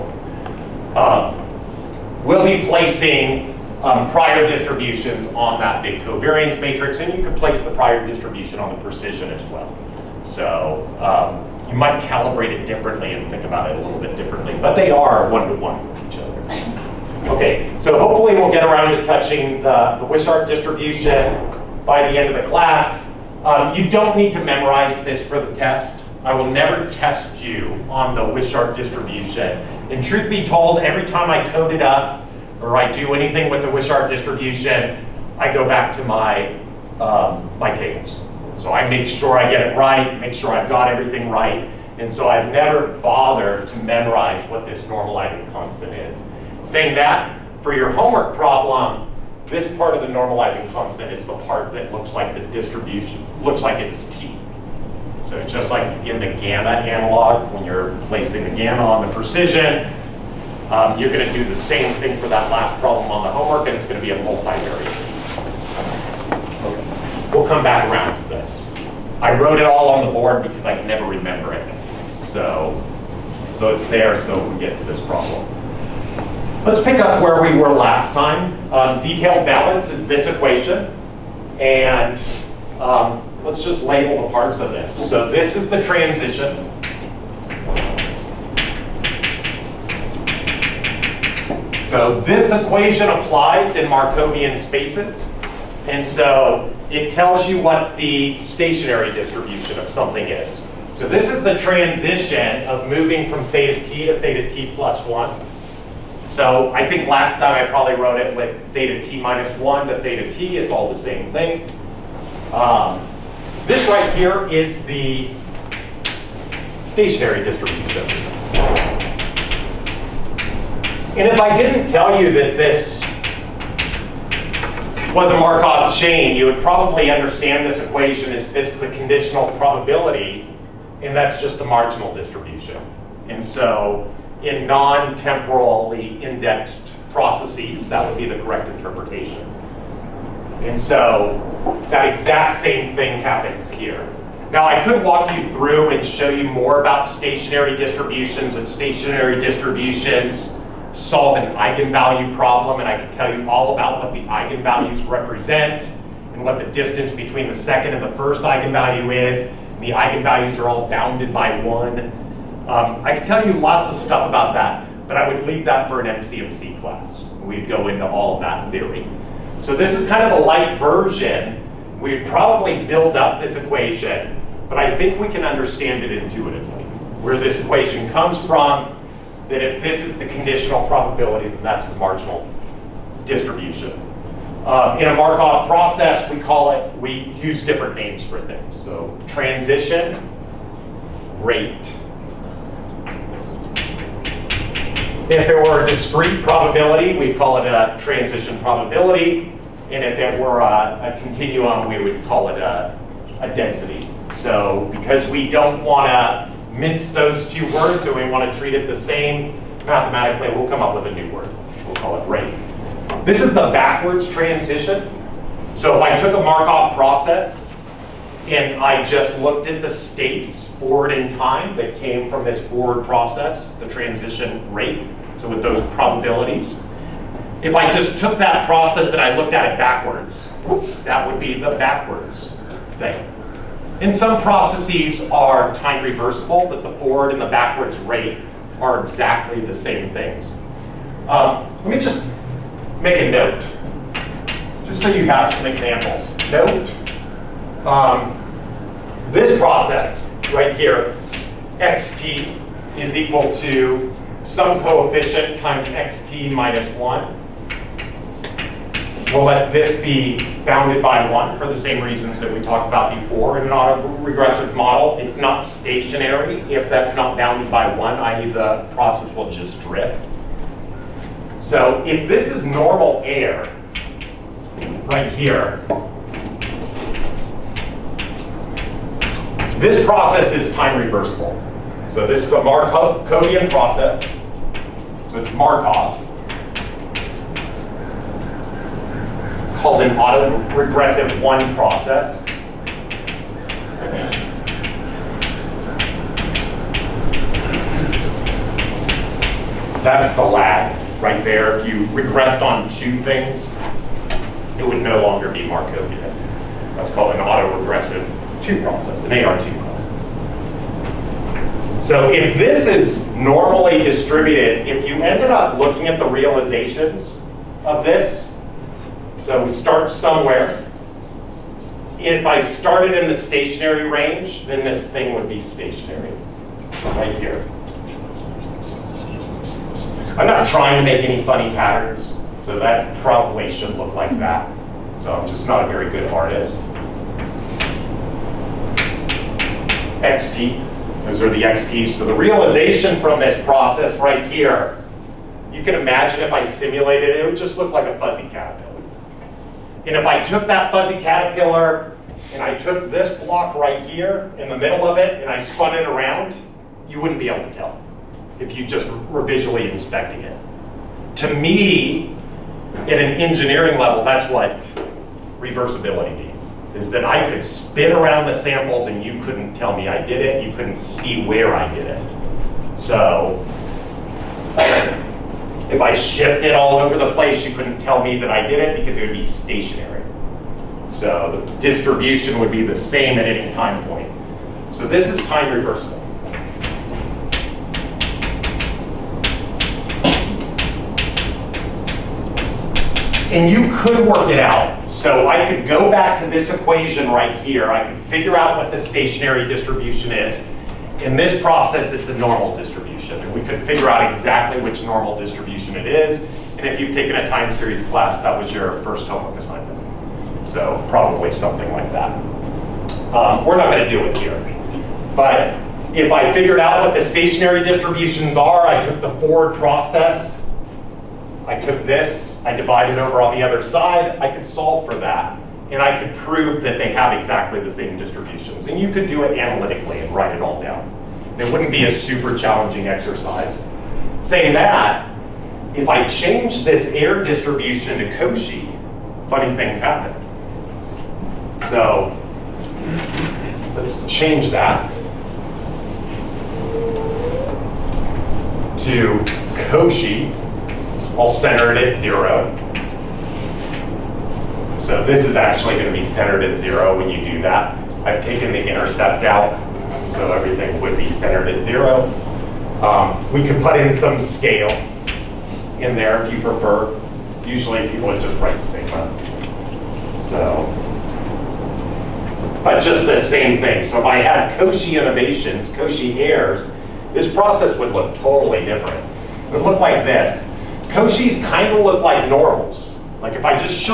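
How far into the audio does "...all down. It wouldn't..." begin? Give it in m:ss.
7:10.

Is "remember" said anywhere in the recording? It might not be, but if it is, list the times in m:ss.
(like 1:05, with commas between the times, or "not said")
1:11.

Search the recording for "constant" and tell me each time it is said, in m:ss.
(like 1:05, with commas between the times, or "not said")
0:45, 0:50.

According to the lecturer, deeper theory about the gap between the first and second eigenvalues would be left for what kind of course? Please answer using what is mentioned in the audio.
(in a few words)
MCMC class.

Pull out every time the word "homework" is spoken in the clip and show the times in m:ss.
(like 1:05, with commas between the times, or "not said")
0:47, 1:03, 6:49.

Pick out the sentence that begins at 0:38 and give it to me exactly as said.
So I make sure I get it right, make sure I've got everything right.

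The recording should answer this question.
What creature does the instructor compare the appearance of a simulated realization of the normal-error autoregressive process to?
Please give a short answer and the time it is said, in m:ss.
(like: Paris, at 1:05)
fuzzy caterpillar, at 5:50.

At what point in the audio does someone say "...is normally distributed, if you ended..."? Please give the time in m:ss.
5:12.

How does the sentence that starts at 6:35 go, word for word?
So I could go back to this equation right here.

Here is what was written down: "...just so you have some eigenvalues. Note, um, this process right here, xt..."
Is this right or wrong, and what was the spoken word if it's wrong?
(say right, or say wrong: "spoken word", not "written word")
wrong: "examples", not "eigenvalues".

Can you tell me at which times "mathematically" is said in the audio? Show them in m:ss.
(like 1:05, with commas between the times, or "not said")
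3:29.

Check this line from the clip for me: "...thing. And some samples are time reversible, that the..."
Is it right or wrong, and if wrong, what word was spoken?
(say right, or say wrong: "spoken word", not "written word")
wrong: "processes", not "samples".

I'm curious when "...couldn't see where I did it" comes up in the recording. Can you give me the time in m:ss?
6:10.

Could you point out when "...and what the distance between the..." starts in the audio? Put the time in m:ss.
2:36.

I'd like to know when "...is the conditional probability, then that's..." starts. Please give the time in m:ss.
3:00.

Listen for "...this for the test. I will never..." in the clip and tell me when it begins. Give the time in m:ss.
0:25.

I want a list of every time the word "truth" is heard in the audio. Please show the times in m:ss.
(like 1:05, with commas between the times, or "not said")
0:30.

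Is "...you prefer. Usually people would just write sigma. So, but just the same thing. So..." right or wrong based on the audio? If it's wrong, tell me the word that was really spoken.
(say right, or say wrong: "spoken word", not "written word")
right.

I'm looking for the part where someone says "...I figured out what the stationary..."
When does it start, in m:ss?
6:56.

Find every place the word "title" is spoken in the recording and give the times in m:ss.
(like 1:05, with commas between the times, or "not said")
not said.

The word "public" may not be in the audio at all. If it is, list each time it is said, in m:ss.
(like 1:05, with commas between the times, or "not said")
not said.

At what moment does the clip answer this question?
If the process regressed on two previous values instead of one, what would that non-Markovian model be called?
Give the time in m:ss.
5:09.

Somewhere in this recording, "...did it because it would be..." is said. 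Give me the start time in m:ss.
6:18.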